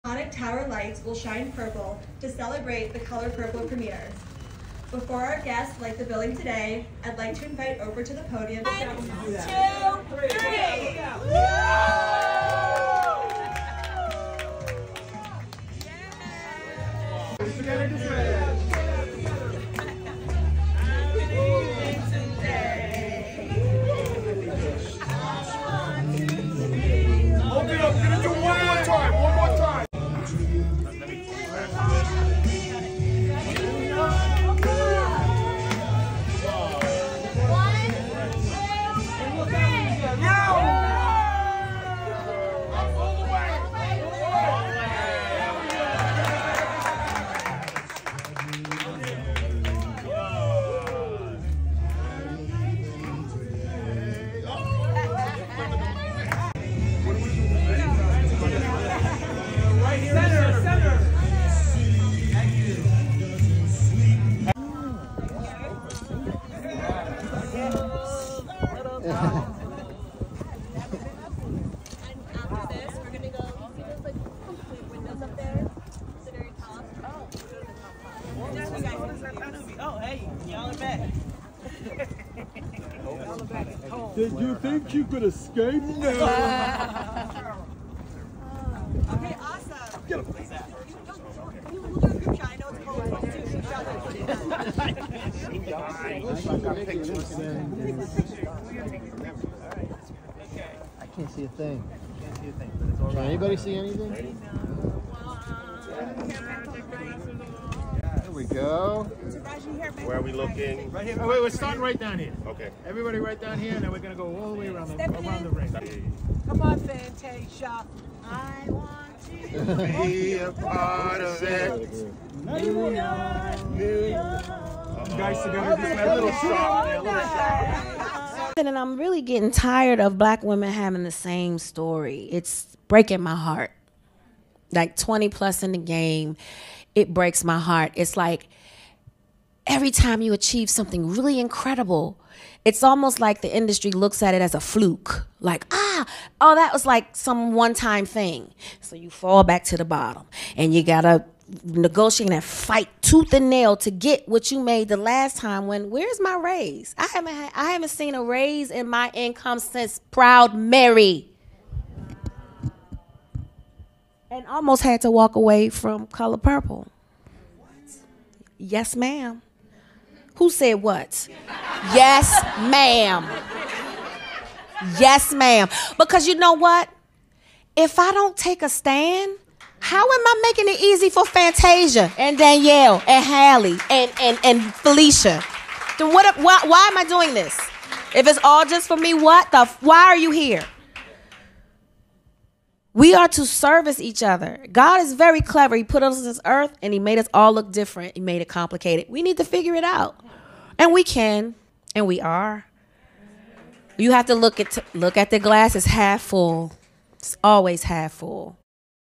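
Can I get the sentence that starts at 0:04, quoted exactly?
Before our guests light the building today, I'd like to invite over to the podium.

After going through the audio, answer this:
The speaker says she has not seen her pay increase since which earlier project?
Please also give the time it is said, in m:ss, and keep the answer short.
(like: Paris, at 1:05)
Proud Mary, at 2:40.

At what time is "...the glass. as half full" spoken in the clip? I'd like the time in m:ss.
3:25.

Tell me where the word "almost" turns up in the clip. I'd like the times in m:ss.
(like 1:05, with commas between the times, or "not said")
2:22, 2:44.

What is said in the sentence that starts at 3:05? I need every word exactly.
Then what, why, why am I doing this?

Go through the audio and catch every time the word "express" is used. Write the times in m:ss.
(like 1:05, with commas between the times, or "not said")
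not said.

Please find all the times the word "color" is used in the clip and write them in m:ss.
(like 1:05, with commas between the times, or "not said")
0:02, 2:46.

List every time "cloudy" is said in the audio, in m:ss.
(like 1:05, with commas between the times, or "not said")
not said.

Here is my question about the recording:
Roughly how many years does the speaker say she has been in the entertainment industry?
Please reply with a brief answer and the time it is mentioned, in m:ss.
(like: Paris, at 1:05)
20 plus, at 2:14.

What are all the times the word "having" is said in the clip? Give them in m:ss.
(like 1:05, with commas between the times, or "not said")
2:10.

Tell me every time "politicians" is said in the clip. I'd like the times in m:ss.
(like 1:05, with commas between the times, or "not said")
not said.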